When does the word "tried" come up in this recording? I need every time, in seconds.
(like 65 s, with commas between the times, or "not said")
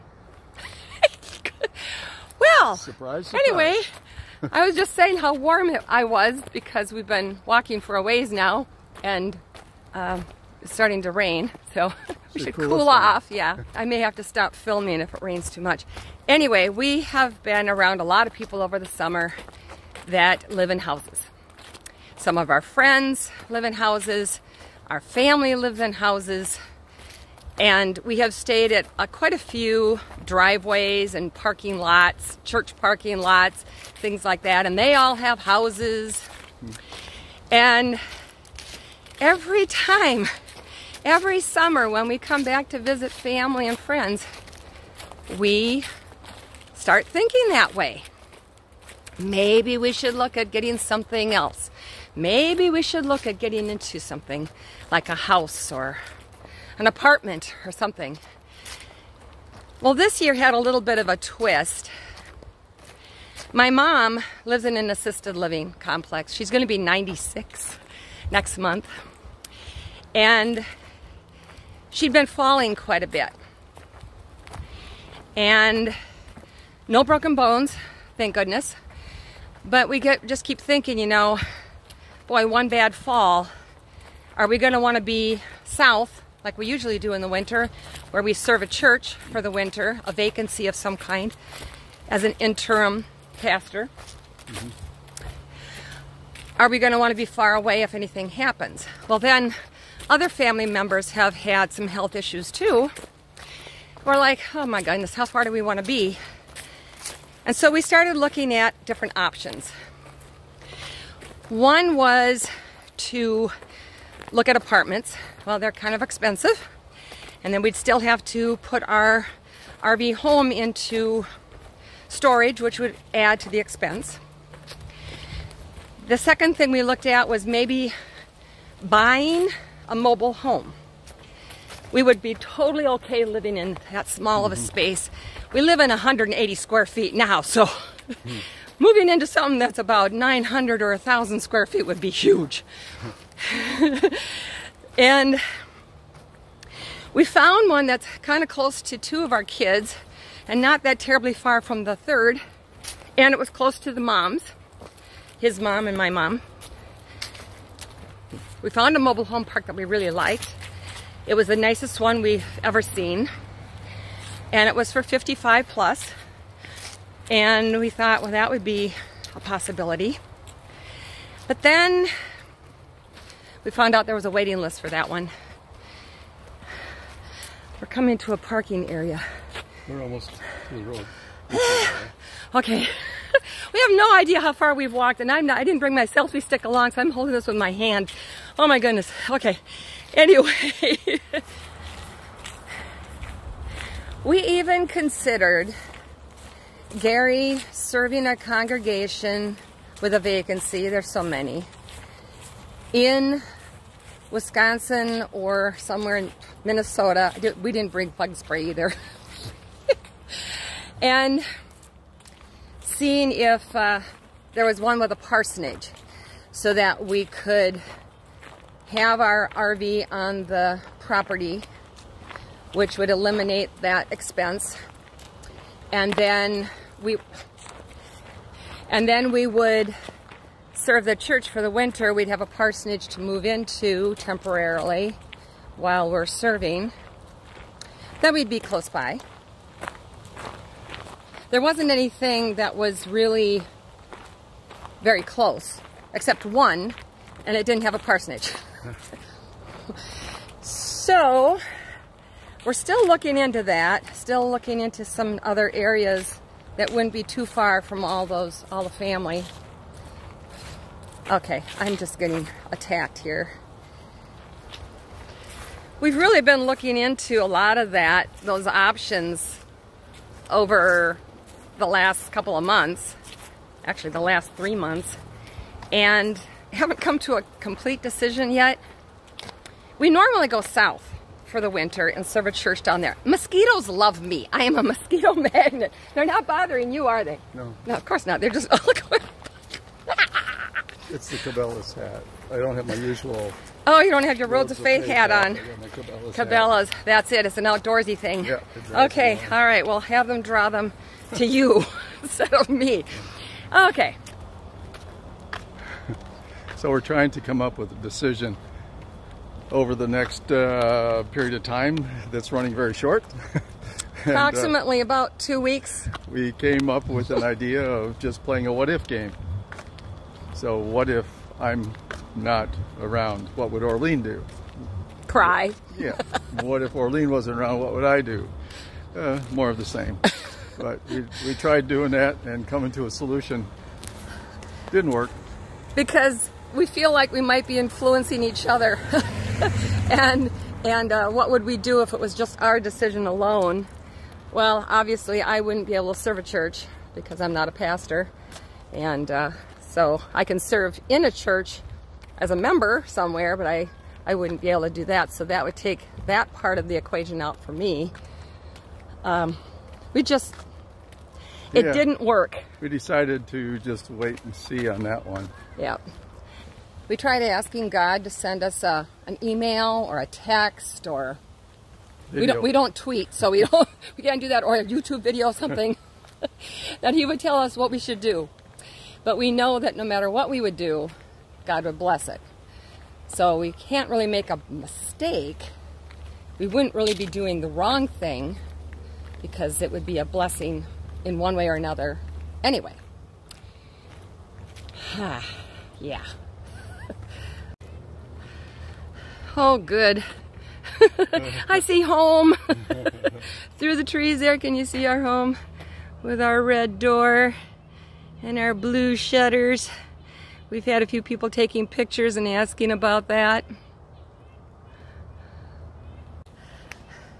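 331 s, 367 s.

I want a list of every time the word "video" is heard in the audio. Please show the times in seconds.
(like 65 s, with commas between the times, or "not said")
375 s.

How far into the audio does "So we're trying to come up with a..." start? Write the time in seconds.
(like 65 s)
306 s.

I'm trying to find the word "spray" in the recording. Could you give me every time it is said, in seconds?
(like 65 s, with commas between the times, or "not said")
208 s.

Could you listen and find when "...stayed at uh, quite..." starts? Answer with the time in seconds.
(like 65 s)
28 s.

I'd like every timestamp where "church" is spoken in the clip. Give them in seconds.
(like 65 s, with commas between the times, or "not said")
32 s, 88 s, 231 s, 282 s, 346 s, 351 s.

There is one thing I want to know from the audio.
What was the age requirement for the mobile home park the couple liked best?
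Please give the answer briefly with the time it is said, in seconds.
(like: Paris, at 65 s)
55 plus, at 165 s.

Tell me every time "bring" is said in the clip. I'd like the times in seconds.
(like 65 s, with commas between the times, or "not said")
185 s, 207 s.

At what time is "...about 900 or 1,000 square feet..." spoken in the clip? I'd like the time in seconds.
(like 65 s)
139 s.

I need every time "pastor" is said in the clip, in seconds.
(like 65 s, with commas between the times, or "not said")
93 s, 347 s.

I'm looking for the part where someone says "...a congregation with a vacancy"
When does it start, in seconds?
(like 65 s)
198 s.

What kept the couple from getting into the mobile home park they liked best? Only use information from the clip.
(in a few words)
A waiting list.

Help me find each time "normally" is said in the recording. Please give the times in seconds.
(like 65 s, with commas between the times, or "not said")
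280 s.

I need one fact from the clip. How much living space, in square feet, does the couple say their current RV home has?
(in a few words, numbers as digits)
180.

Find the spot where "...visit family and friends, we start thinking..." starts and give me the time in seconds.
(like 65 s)
42 s.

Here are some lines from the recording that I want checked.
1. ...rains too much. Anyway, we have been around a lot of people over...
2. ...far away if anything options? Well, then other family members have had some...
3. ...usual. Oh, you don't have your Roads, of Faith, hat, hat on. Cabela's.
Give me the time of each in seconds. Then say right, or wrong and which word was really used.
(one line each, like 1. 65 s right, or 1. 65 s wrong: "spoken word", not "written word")
1. 15 s right
2. 97 s wrong: "happens", not "options"
3. 292 s right.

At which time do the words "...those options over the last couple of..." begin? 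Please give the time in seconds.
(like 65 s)
268 s.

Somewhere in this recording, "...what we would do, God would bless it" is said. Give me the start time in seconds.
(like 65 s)
380 s.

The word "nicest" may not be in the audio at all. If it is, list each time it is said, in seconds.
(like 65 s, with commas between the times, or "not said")
161 s.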